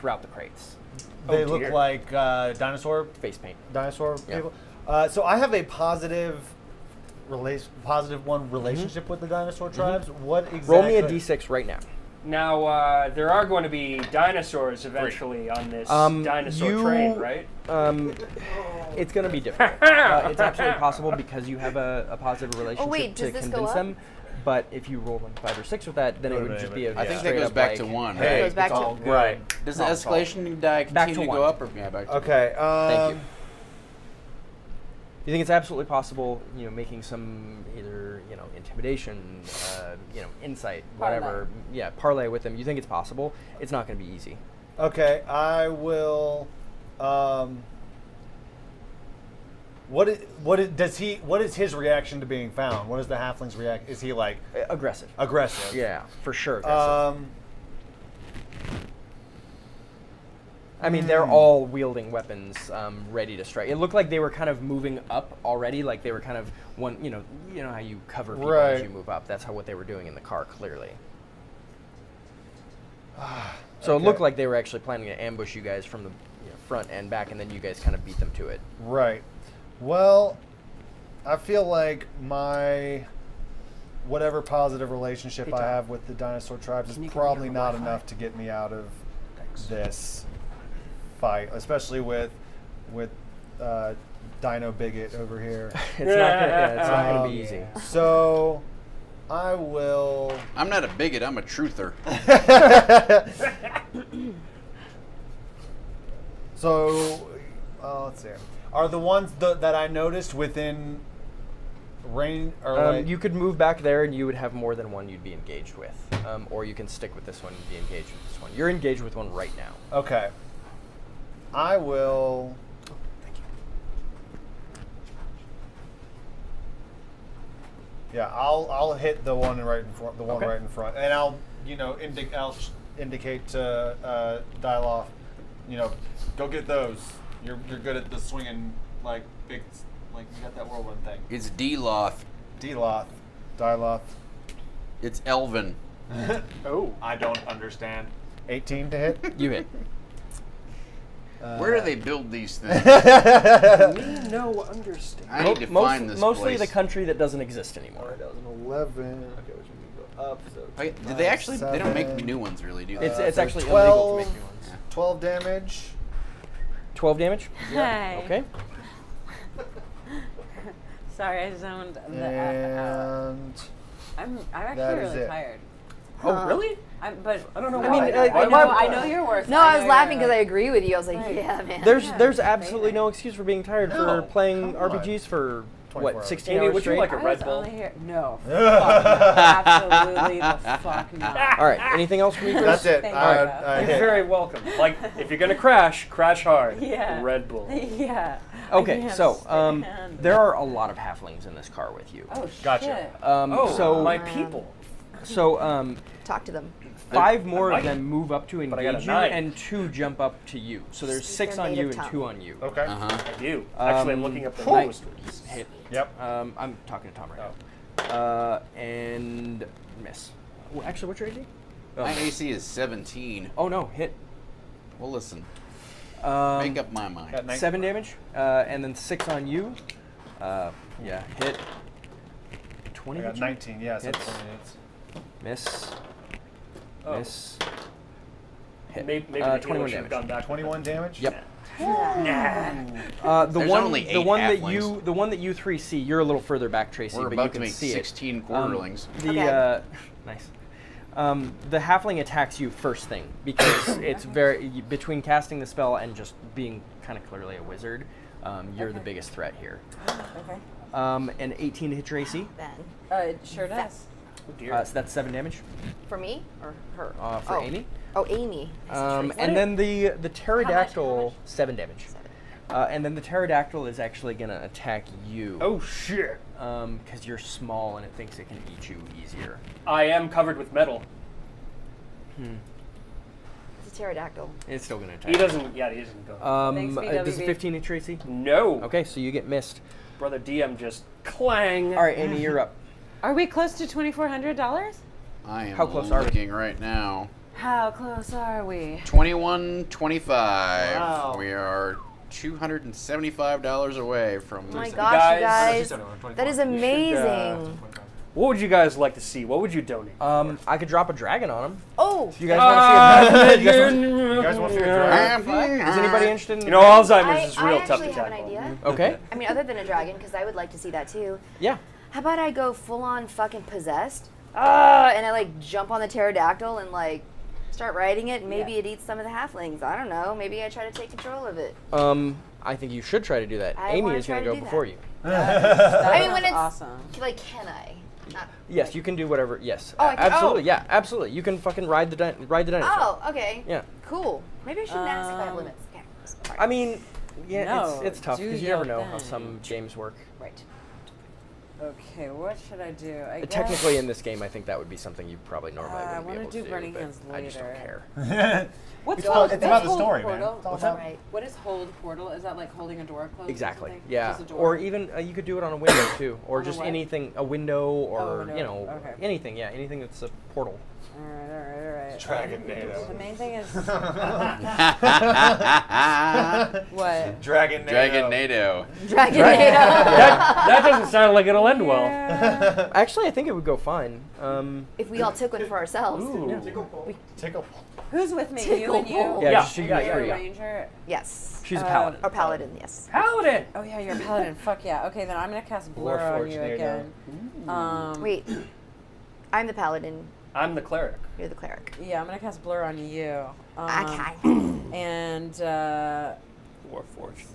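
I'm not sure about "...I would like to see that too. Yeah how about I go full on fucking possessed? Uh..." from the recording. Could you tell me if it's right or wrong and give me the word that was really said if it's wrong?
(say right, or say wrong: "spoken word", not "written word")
right.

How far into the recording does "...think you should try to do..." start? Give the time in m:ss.
5:32.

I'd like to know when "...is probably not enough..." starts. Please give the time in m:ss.
1:26.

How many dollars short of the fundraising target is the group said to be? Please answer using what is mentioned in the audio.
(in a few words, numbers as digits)
$275.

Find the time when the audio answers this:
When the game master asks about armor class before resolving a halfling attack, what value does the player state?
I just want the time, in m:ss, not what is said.
3:42.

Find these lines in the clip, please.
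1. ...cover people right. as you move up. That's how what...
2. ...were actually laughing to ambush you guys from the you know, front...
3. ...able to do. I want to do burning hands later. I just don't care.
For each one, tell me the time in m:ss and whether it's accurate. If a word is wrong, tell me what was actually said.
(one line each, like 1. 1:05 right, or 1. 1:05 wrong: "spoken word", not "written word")
1. 1:08 right
2. 1:14 wrong: "planning", not "laughing"
3. 5:56 right.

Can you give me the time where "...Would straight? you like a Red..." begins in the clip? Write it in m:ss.
3:06.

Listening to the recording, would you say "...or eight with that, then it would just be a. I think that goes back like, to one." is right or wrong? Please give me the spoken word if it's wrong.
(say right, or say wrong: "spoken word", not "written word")
wrong: "six", not "eight".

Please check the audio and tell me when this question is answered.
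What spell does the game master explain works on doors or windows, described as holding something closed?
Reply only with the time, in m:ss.
6:01.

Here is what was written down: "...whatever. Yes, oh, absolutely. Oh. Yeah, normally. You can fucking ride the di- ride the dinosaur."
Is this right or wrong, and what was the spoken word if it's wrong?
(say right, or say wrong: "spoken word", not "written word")
wrong: "absolutely", not "normally".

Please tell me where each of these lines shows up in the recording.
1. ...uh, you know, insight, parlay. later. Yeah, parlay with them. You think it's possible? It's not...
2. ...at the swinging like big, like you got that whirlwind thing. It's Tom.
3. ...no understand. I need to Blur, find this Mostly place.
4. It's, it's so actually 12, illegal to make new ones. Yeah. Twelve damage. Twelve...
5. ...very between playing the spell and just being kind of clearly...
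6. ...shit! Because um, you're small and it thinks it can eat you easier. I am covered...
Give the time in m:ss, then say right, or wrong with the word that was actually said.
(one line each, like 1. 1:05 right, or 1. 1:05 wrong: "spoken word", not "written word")
1. 0:39 wrong: "whatever", not "later"
2. 2:17 wrong: "Deeloth", not "Tom"
3. 2:34 wrong: "Most", not "Blur"
4. 2:43 right
5. 4:14 wrong: "casting", not "playing"
6. 4:35 right.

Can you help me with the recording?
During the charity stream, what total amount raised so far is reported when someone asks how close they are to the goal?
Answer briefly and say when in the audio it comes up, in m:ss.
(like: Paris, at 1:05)
2125, at 4:59.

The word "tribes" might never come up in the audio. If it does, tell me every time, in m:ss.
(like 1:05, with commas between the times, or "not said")
0:09, 1:26.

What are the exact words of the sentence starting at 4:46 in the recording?
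Um, Thanks, uh, does a 15 hit Traycee?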